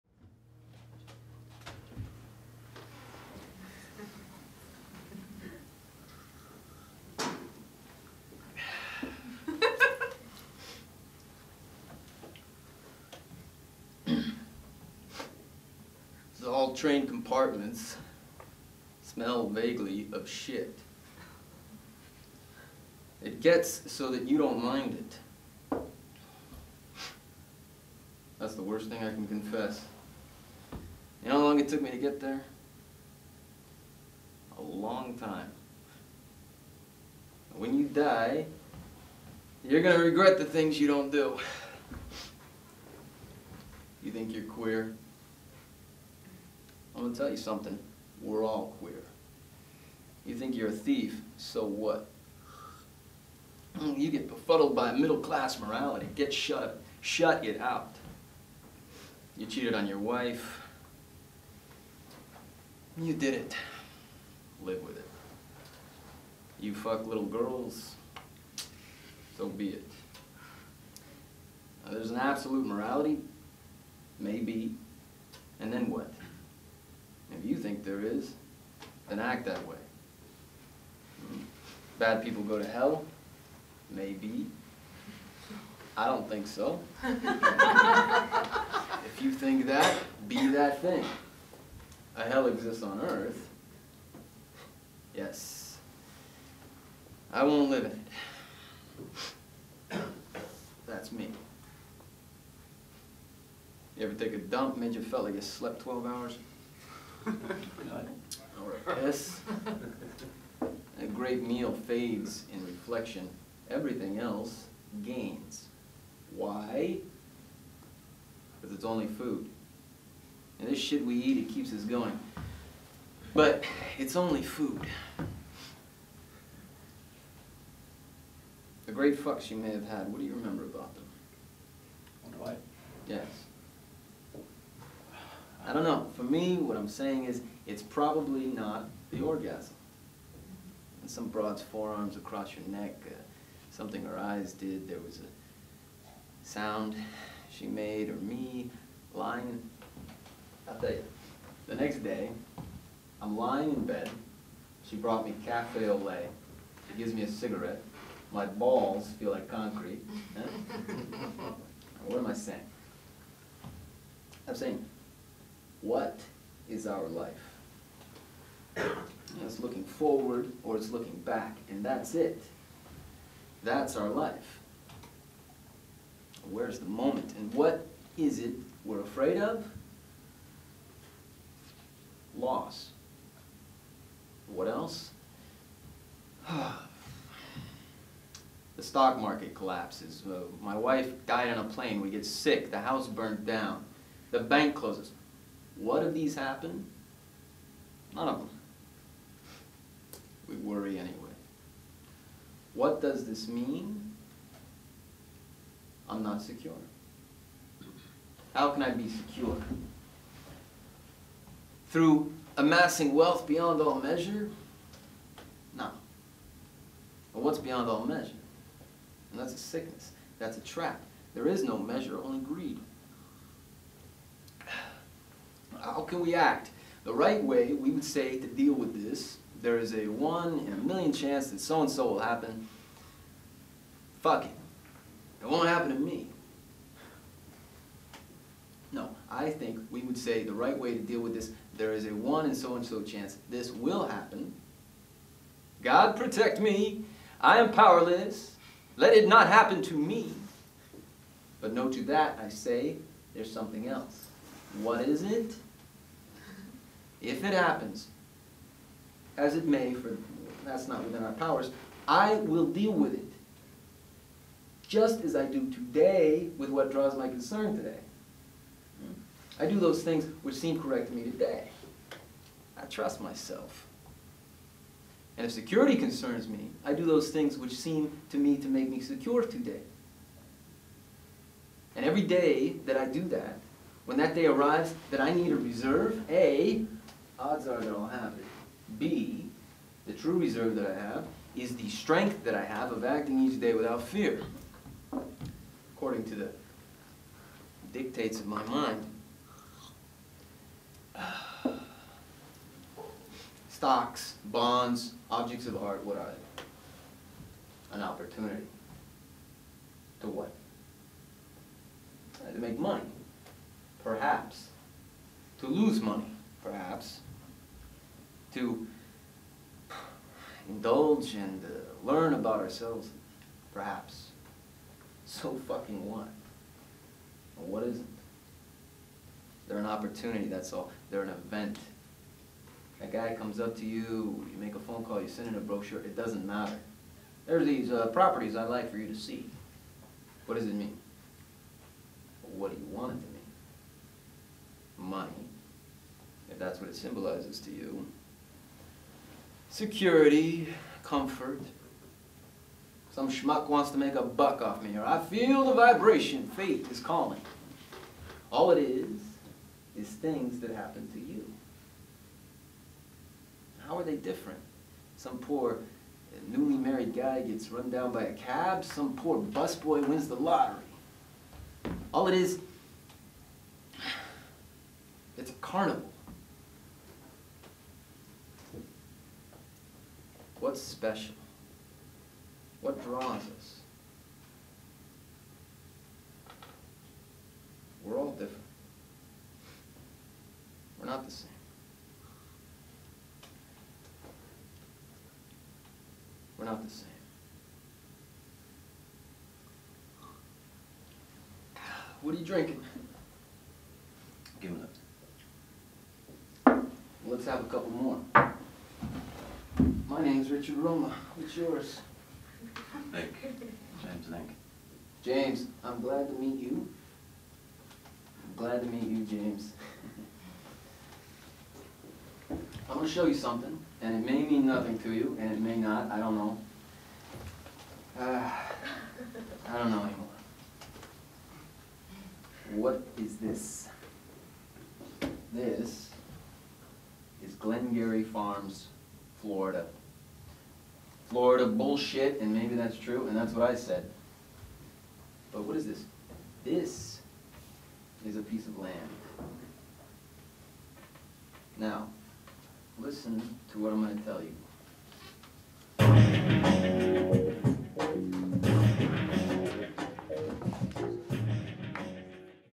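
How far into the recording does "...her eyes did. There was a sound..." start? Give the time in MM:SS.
02:24.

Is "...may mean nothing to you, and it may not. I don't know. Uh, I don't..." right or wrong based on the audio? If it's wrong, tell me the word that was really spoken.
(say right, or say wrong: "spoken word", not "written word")
right.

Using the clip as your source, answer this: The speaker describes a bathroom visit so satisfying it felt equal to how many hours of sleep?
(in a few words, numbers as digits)
12.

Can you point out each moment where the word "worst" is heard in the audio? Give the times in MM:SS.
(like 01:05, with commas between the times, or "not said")
00:28.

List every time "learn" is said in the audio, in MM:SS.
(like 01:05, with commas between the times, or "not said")
05:22.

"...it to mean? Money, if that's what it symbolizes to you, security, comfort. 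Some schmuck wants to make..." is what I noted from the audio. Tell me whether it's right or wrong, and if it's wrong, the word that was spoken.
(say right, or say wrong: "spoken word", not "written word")
right.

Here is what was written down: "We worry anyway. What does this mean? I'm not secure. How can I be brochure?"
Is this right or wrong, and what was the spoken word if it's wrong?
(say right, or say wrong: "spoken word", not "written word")
wrong: "secure", not "brochure".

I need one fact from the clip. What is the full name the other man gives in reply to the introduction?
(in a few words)
James Lingk.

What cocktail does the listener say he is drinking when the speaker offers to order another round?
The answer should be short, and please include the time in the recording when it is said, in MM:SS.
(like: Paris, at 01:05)
Gimlet, at 06:44.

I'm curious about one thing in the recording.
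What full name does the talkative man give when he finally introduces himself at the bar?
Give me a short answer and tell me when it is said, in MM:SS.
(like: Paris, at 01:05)
Richard Roma, at 06:50.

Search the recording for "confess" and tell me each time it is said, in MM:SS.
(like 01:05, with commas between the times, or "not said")
00:29.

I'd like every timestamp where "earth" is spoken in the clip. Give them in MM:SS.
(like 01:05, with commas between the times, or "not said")
01:33.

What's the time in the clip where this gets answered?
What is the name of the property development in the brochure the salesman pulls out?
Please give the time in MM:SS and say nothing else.
07:17.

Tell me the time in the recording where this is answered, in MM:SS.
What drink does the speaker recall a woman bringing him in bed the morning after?
02:35.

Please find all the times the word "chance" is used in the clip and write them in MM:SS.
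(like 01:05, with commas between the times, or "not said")
03:51, 04:03.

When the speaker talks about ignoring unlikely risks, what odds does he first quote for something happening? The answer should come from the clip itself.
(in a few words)
one in a million.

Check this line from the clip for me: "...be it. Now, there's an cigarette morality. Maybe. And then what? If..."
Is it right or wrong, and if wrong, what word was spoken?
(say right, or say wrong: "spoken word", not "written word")
wrong: "absolute", not "cigarette".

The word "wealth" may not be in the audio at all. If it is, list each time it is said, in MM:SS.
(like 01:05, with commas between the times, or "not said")
03:33.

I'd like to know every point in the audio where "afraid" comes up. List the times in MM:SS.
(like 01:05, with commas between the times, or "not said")
02:59.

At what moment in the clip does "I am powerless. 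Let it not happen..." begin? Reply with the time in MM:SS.
04:07.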